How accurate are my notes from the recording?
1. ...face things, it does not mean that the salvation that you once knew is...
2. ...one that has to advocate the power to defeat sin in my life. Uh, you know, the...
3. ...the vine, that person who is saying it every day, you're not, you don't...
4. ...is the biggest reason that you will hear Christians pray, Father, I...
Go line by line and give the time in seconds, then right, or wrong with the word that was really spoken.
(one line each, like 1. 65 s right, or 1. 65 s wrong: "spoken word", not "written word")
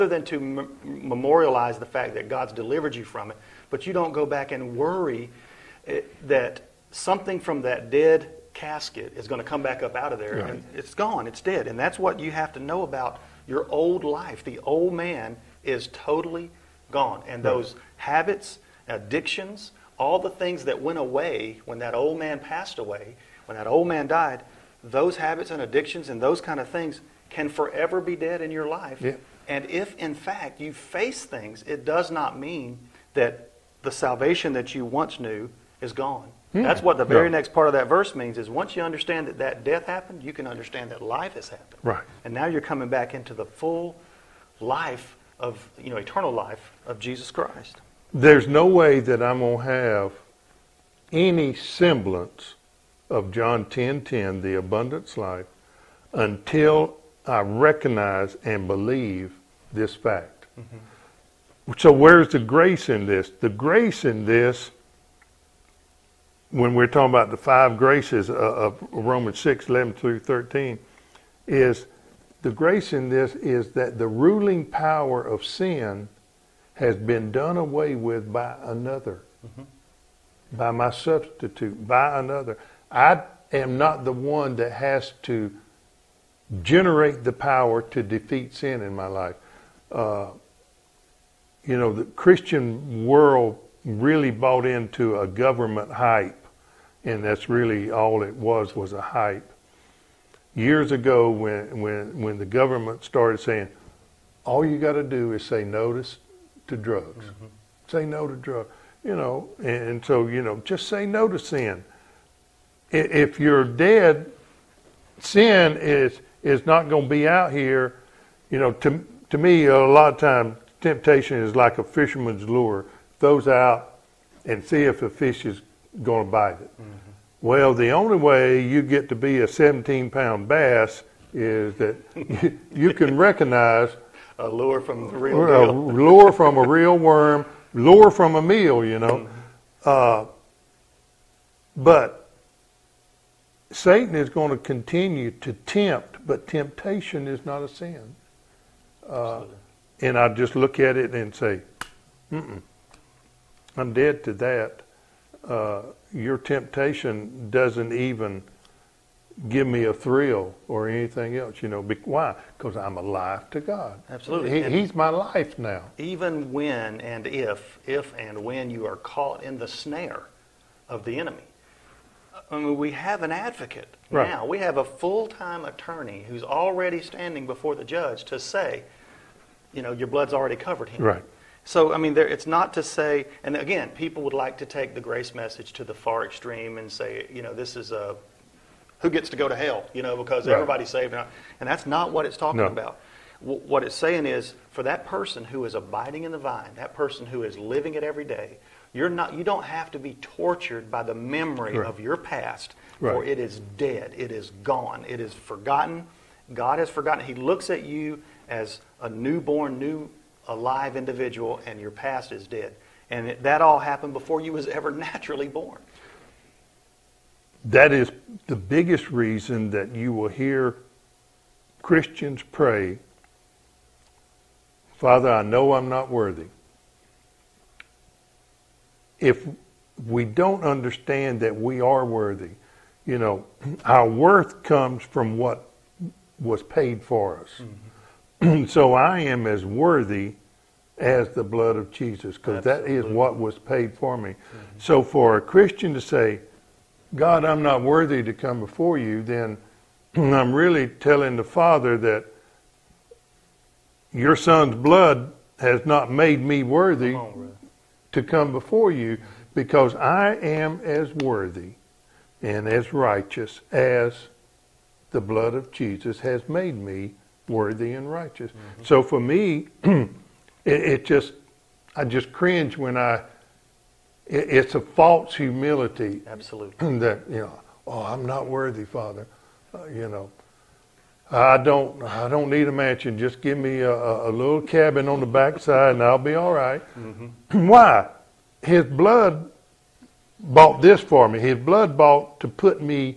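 1. 30 s right
2. 84 s wrong: "generate", not "advocate"
3. 196 s wrong: "living", not "saying"
4. 217 s right.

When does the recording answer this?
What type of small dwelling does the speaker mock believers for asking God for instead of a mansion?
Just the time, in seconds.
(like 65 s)
284 s.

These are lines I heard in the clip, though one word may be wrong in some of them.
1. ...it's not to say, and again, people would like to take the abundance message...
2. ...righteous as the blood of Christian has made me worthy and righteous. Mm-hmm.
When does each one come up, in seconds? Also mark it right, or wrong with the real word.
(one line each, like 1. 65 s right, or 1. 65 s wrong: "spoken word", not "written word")
1. 182 s wrong: "grace", not "abundance"
2. 262 s wrong: "Jesus", not "Christian".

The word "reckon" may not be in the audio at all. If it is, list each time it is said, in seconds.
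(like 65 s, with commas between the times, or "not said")
not said.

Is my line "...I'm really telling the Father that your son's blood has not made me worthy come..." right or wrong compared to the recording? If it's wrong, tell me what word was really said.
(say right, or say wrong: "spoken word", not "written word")
right.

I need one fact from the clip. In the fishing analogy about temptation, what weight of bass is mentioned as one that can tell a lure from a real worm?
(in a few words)
17 pound.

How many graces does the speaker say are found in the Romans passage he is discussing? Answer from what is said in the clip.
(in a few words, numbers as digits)
5.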